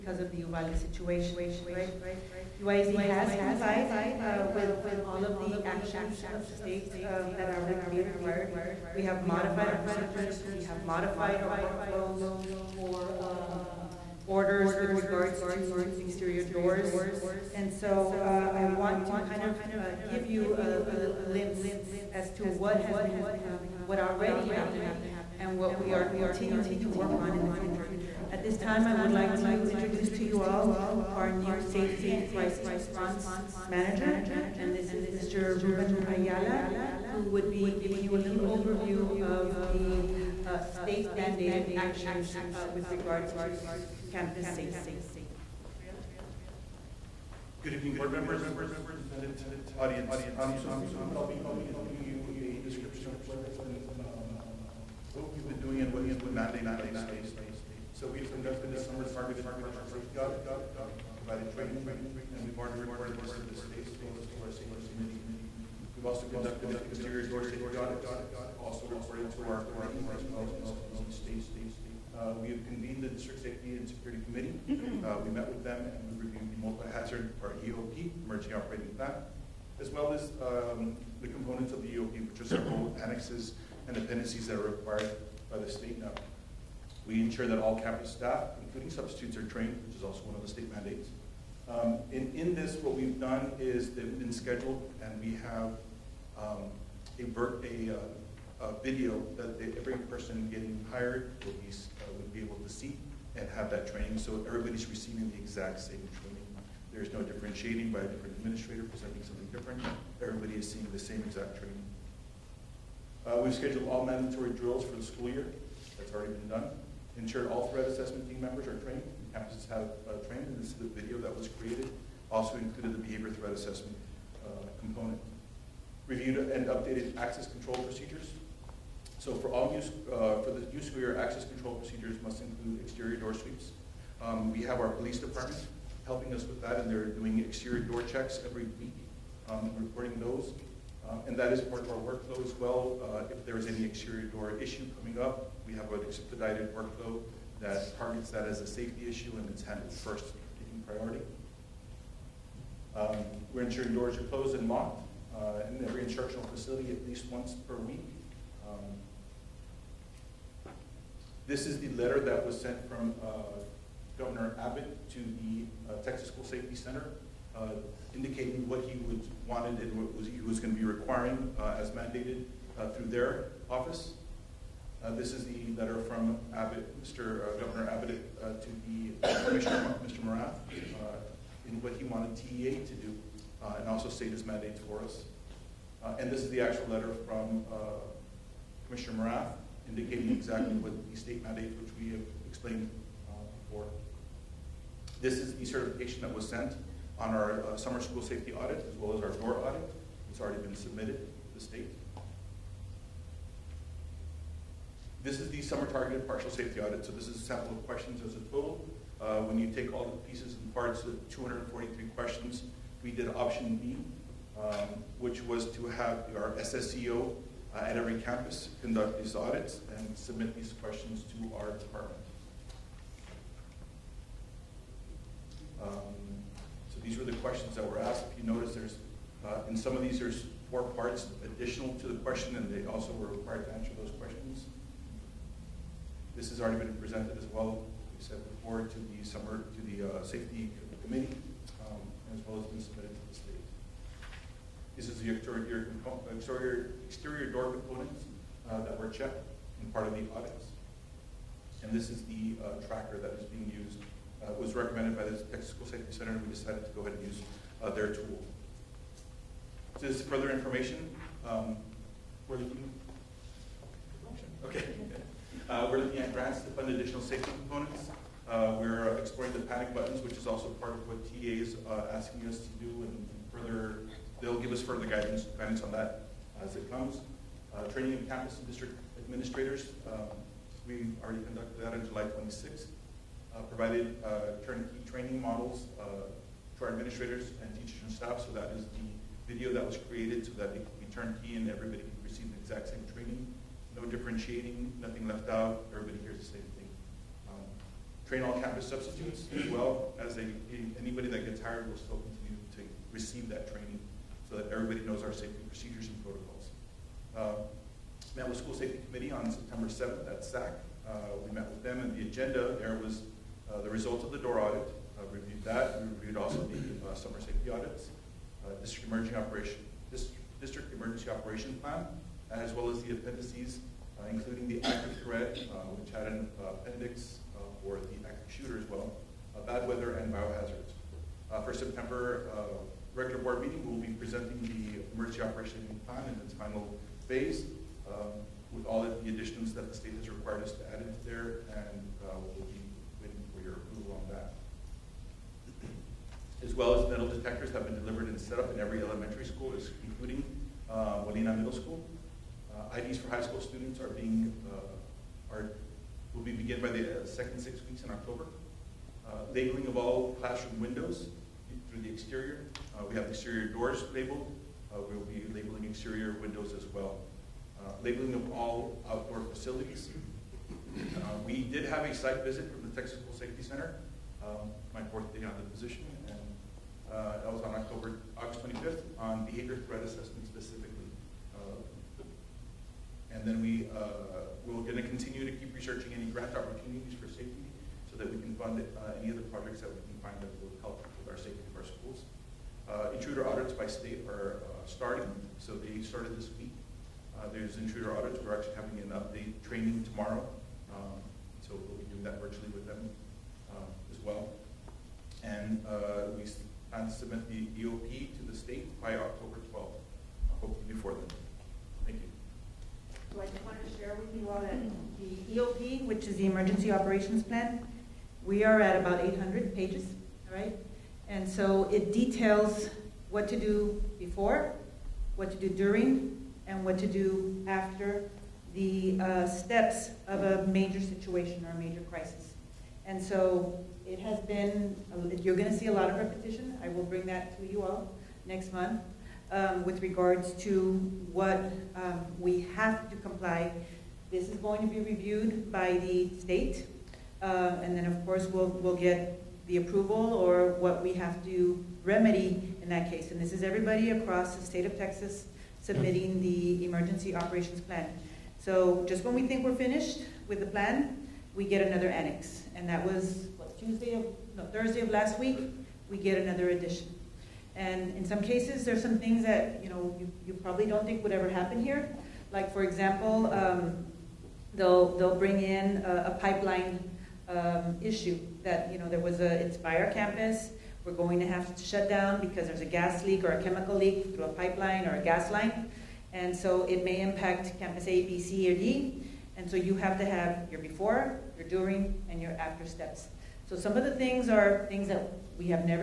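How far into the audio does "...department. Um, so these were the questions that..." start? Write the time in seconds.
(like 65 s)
221 s.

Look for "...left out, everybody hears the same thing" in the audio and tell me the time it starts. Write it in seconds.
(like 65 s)
295 s.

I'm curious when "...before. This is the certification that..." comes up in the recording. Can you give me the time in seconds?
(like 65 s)
193 s.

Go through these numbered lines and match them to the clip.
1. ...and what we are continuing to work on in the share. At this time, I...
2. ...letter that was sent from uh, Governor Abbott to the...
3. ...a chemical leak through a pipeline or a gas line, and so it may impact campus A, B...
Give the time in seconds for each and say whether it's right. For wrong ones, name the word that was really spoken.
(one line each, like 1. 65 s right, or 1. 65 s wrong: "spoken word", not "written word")
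1. 25 s wrong: "future", not "share"
2. 161 s right
3. 483 s right.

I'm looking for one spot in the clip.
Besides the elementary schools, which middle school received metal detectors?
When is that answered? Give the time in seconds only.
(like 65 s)
351 s.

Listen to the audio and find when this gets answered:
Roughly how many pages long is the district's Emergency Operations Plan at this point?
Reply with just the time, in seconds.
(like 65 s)
419 s.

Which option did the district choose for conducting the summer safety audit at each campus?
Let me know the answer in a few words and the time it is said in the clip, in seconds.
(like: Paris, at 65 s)
option B, at 213 s.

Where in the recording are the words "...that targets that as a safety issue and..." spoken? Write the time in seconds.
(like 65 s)
147 s.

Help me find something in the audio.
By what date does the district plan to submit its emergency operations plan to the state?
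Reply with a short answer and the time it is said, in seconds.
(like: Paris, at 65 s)
October 12th, at 409 s.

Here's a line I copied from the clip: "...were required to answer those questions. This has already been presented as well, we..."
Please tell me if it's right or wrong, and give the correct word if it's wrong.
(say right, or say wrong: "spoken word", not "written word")
right.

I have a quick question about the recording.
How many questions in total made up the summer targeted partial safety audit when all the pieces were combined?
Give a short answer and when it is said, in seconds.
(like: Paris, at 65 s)
243, at 211 s.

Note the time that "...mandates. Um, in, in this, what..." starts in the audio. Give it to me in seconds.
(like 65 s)
90 s.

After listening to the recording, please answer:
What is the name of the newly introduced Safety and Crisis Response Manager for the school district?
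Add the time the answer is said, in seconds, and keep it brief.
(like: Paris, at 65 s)
Ruben Ayala, at 35 s.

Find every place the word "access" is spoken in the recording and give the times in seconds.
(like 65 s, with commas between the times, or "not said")
127 s, 131 s.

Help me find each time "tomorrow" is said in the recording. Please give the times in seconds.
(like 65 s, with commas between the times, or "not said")
400 s.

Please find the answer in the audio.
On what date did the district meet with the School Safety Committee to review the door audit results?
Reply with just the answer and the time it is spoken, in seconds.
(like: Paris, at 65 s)
September 7th, at 309 s.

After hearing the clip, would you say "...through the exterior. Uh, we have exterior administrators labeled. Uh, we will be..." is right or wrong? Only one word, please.
wrong.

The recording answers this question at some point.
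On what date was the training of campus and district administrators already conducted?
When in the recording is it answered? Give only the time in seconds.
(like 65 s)
282 s.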